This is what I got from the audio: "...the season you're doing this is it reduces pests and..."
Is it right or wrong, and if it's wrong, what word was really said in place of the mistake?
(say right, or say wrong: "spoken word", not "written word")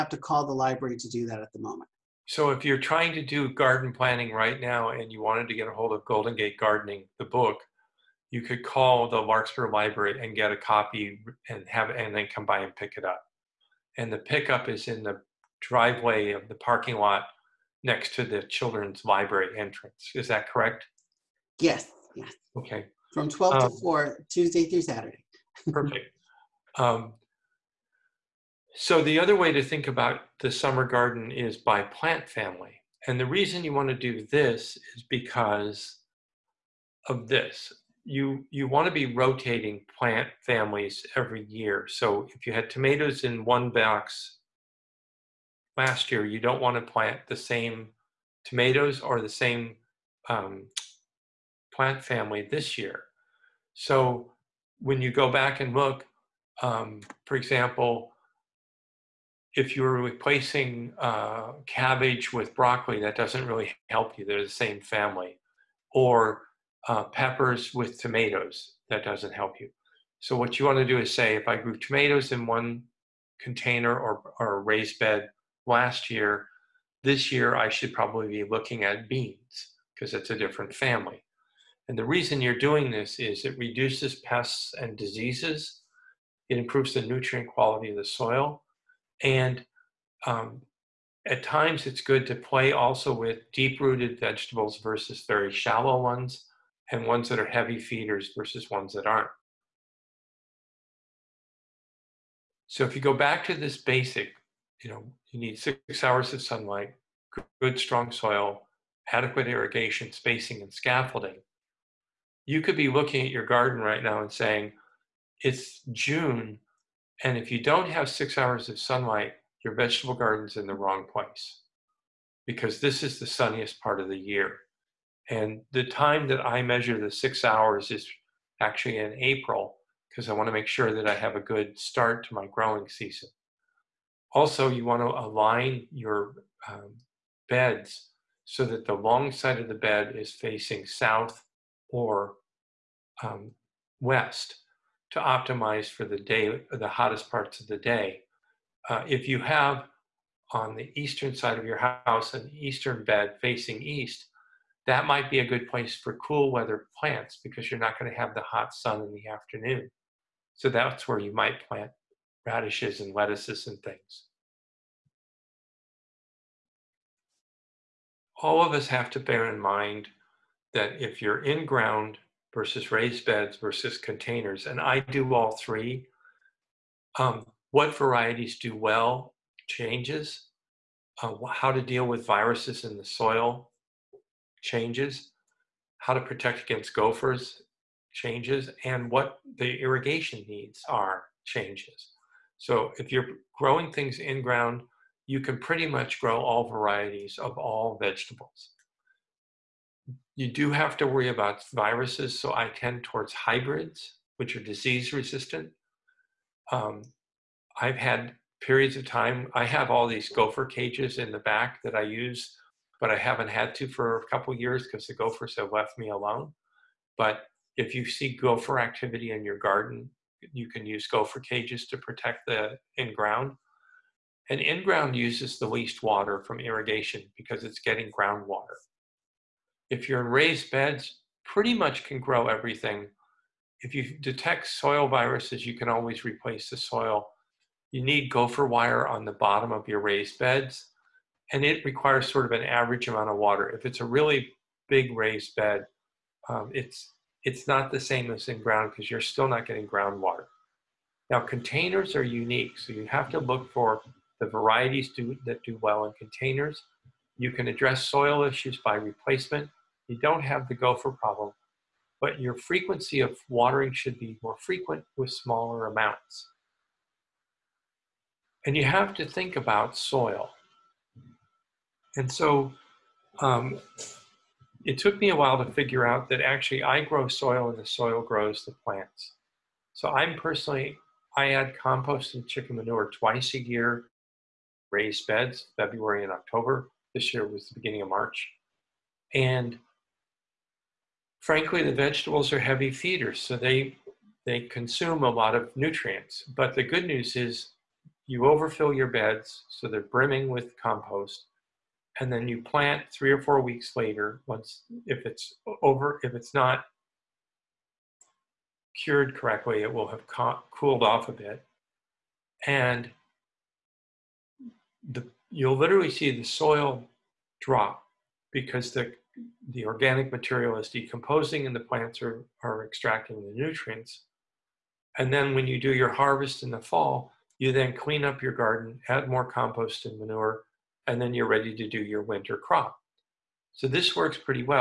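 wrong: "reason", not "season".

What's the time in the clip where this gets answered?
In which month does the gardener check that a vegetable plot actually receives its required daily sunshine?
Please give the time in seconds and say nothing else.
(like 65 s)
129 s.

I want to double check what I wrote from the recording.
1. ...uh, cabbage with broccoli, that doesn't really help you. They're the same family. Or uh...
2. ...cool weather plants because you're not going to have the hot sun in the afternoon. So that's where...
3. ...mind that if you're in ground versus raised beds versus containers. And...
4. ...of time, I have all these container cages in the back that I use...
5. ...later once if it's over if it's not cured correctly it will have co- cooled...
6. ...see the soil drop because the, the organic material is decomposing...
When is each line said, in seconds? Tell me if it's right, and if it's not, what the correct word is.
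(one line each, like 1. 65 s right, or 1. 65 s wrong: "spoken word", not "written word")
1. 60 s right
2. 156 s right
3. 169 s right
4. 208 s wrong: "gopher", not "container"
5. 303 s right
6. 316 s right.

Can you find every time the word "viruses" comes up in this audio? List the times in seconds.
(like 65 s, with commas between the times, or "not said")
182 s, 201 s, 235 s.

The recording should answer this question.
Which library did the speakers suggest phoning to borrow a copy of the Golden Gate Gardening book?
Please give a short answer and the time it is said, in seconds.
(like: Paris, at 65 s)
Larkspur Library, at 9 s.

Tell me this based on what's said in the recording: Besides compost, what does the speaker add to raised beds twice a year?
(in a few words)
Chicken manure.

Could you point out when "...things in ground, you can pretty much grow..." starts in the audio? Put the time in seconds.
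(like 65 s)
193 s.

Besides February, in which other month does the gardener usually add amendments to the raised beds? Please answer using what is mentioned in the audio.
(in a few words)
October.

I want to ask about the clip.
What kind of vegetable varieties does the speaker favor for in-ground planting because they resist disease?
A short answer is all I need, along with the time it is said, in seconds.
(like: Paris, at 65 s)
Hybrids, at 203 s.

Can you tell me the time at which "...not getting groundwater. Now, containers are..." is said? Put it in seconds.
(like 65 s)
249 s.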